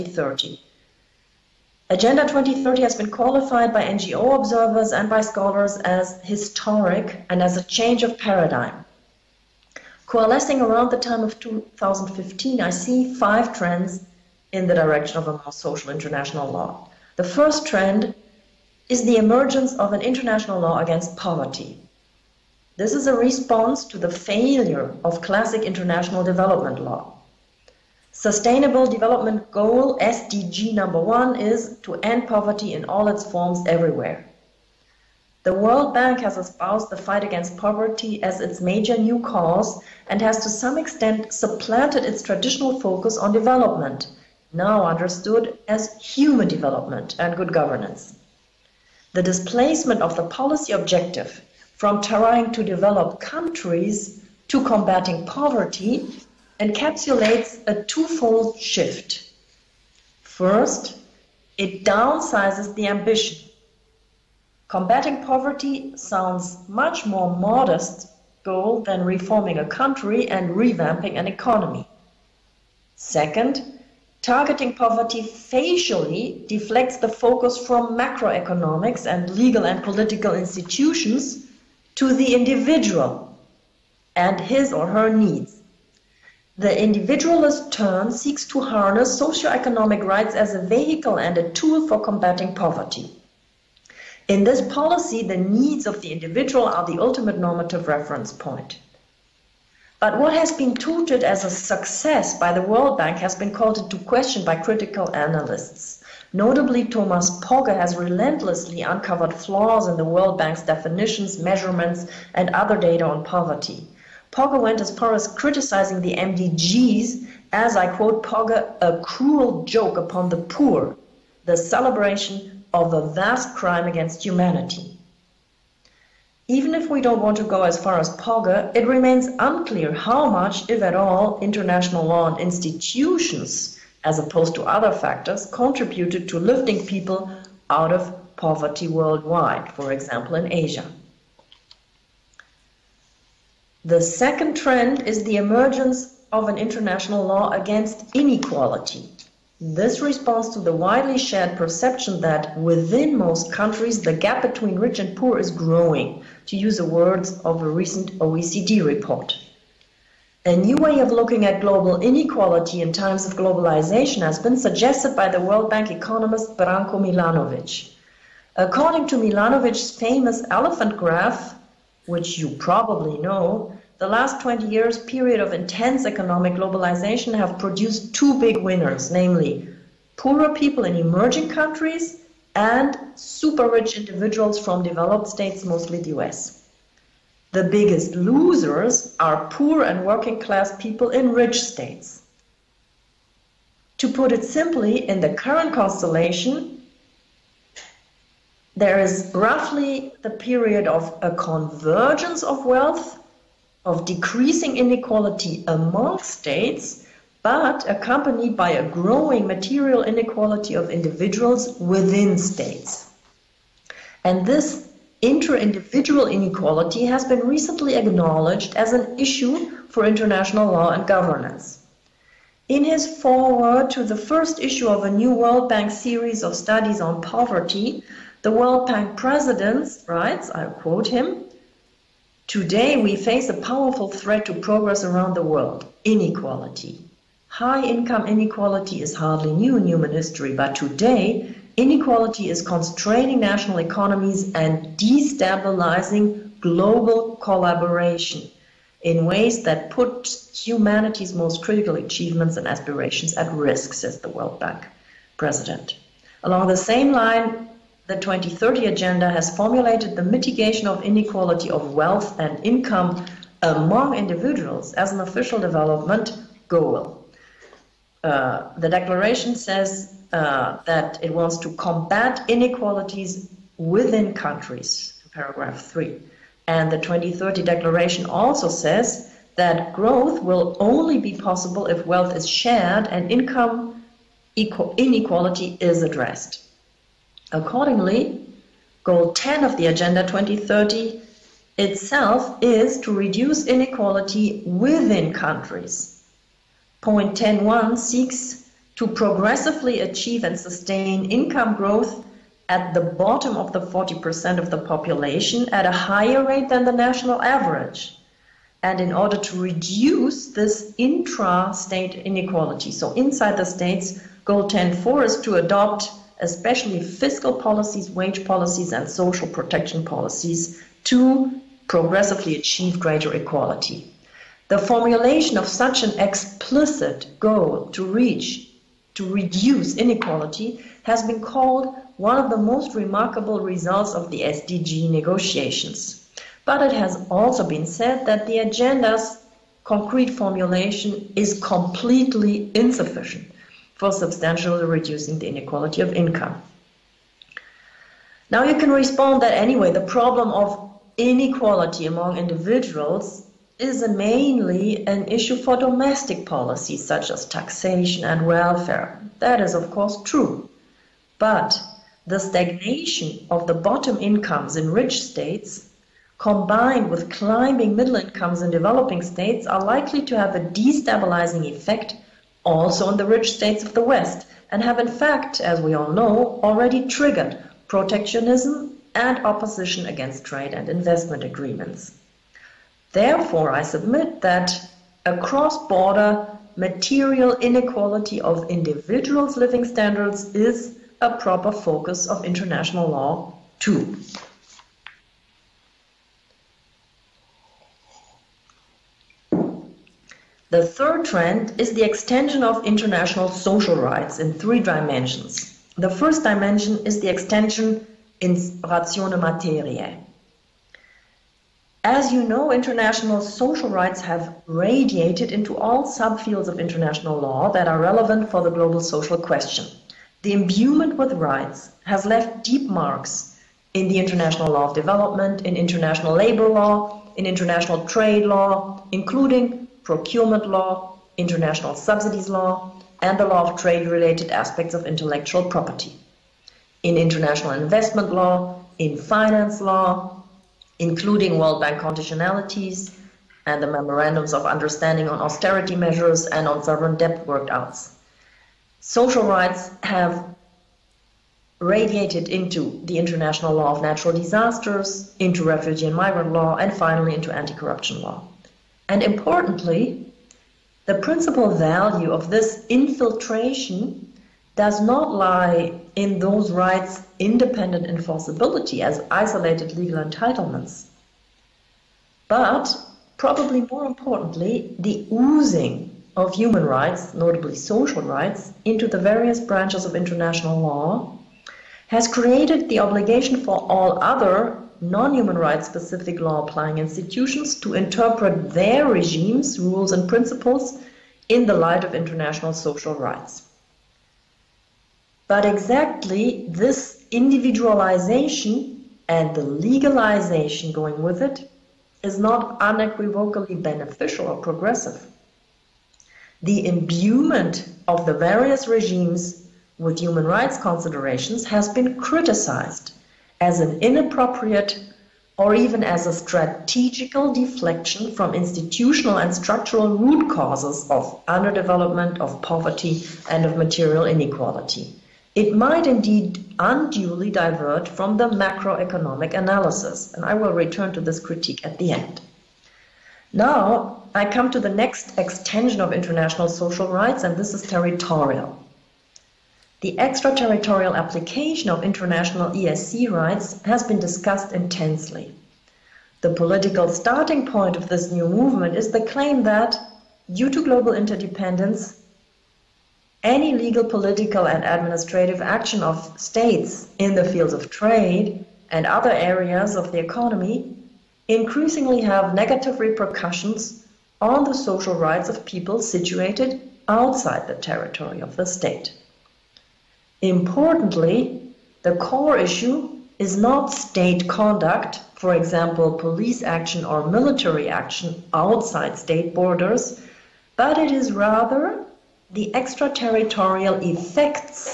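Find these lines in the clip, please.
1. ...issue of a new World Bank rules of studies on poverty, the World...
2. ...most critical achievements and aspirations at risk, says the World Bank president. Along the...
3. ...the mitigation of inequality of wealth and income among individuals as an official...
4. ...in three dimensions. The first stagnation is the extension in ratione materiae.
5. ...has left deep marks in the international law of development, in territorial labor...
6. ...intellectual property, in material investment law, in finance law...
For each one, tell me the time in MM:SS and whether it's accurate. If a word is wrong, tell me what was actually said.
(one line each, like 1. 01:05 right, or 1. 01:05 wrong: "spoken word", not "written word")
1. 03:44 wrong: "series", not "rules"
2. 04:11 right
3. 04:20 right
4. 06:44 wrong: "dimension", not "stagnation"
5. 07:02 wrong: "international", not "territorial"
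6. 07:15 wrong: "international", not "material".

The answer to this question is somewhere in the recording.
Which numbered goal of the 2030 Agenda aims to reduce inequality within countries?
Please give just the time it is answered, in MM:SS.
04:49.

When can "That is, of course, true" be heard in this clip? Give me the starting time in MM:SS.
05:59.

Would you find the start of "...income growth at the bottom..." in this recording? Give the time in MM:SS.
05:01.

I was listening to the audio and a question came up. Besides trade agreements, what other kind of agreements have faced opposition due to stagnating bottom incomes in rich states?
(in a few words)
investment agreements.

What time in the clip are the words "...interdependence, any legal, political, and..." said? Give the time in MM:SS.
09:11.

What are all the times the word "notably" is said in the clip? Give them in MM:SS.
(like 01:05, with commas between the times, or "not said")
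01:46, 07:57.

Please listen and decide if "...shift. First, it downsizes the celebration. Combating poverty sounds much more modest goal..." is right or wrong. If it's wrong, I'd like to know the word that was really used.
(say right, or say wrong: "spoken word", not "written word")
wrong: "ambition", not "celebration".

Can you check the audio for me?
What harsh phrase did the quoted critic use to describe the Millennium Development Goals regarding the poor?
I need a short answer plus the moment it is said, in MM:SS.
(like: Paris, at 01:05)
a cruel joke, at 01:58.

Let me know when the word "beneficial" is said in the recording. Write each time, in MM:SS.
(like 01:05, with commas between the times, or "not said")
08:23.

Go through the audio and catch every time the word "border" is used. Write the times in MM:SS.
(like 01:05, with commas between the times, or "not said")
06:25, 09:39.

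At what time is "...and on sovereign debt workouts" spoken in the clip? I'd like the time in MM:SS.
07:26.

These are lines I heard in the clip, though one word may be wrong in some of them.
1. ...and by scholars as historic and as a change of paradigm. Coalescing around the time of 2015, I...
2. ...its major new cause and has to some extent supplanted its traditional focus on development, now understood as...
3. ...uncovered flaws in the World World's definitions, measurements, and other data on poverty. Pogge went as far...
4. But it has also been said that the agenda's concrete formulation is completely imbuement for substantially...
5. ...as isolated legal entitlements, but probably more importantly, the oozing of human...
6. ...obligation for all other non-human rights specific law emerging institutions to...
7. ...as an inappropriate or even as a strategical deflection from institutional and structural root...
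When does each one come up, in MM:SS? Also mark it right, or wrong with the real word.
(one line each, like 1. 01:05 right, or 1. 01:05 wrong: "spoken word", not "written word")
1. 00:04 right
2. 00:38 right
3. 01:48 wrong: "Bank", not "World"
4. 05:36 wrong: "insufficient", not "imbuement"
5. 07:49 right
6. 08:02 wrong: "applying", not "emerging"
7. 08:33 right.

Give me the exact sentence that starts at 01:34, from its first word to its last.
In this policy, the needs of the individual are the ultimate normative reference point.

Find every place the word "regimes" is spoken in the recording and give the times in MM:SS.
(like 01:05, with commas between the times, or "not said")
08:09, 08:28.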